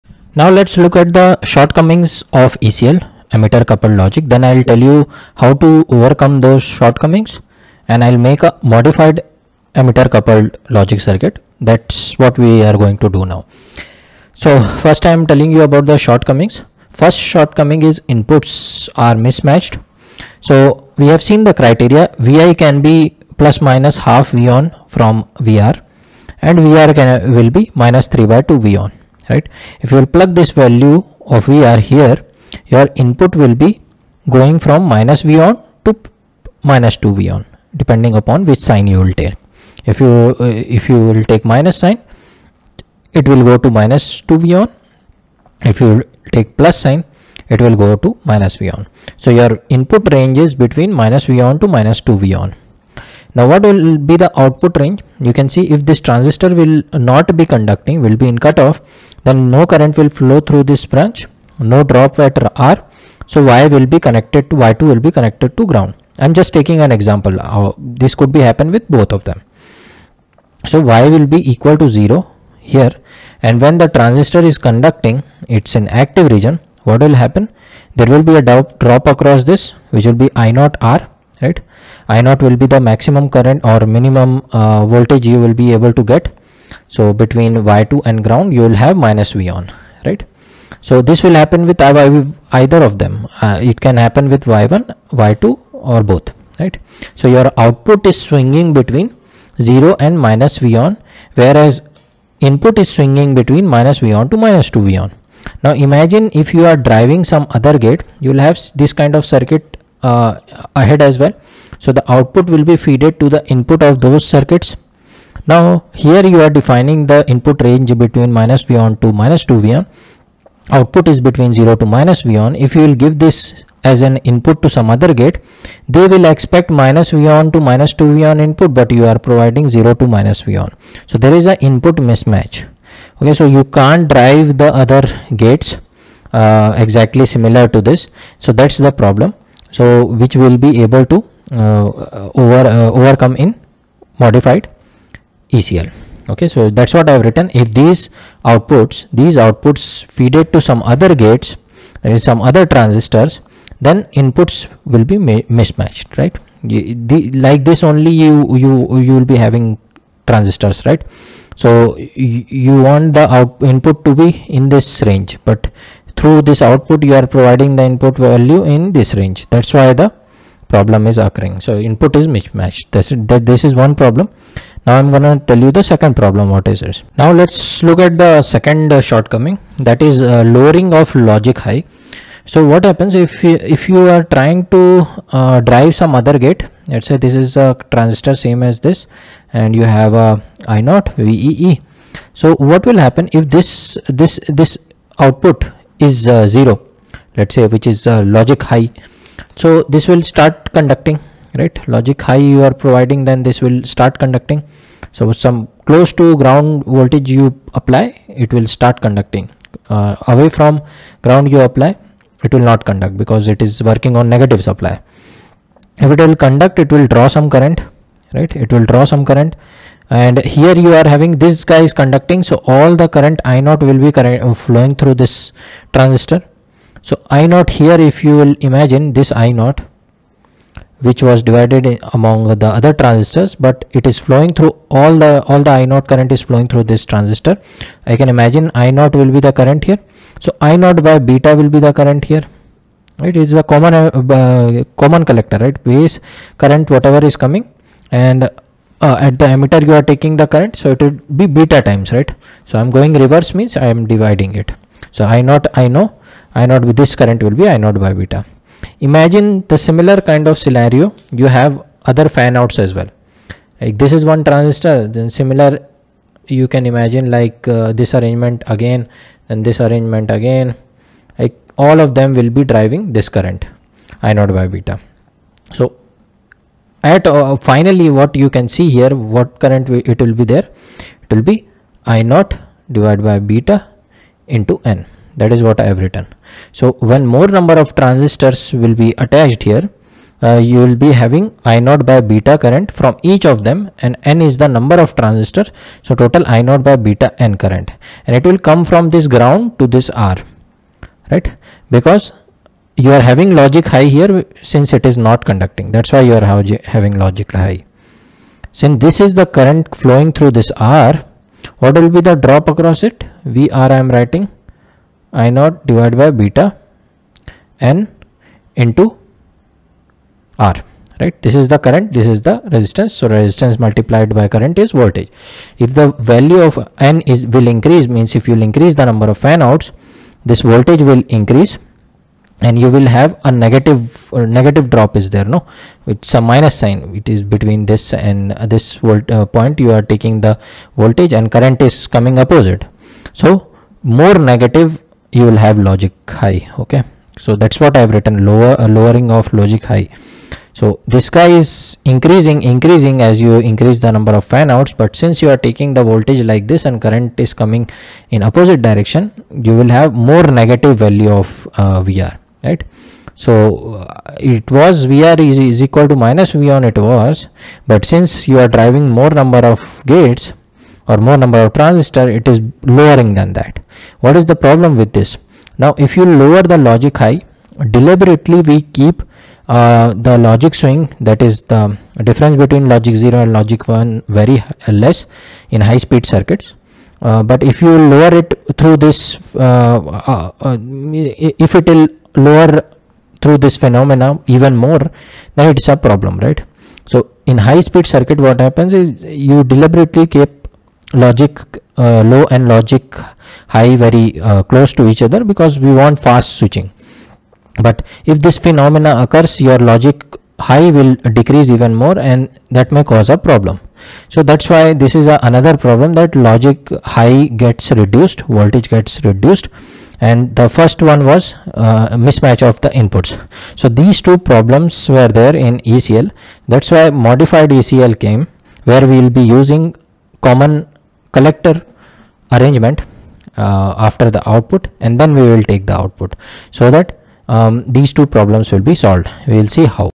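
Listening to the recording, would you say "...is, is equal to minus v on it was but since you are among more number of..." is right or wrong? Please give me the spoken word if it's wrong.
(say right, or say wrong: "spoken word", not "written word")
wrong: "driving", not "among".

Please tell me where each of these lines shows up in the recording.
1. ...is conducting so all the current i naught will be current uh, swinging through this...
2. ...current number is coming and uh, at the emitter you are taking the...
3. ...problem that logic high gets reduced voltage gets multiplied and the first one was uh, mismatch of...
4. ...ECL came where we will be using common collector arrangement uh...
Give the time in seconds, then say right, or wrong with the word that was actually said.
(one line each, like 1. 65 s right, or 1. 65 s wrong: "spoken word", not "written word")
1. 221 s wrong: "flowing", not "swinging"
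2. 246 s wrong: "whatever", not "number"
3. 415 s wrong: "reduced", not "multiplied"
4. 427 s right.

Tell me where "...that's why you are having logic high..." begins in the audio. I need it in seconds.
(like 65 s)
305 s.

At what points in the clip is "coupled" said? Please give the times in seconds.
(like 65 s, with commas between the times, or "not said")
3 s, 10 s.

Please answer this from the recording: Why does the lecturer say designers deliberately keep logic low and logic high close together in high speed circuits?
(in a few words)
Fast switching.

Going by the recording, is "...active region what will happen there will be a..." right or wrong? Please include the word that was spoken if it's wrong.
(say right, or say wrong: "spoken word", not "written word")
right.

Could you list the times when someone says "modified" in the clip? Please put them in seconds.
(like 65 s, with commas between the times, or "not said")
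8 s, 144 s, 427 s.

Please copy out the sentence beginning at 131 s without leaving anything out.
So there is an input mismatch.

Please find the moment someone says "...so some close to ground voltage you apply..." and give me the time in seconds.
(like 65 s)
205 s.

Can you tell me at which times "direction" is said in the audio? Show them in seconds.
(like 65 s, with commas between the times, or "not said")
358 s.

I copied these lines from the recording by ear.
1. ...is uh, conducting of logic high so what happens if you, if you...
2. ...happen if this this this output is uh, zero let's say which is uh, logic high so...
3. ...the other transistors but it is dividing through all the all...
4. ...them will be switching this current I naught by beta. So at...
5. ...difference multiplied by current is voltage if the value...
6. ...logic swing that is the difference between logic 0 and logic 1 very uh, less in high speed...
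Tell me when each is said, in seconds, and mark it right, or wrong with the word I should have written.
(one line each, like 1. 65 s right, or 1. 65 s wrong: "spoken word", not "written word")
1. 180 s wrong: "lowering", not "conducting"
2. 192 s right
3. 232 s wrong: "flowing", not "dividing"
4. 272 s wrong: "driving", not "switching"
5. 323 s wrong: "resistance", not "difference"
6. 380 s right.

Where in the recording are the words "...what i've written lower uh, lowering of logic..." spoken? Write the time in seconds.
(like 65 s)
347 s.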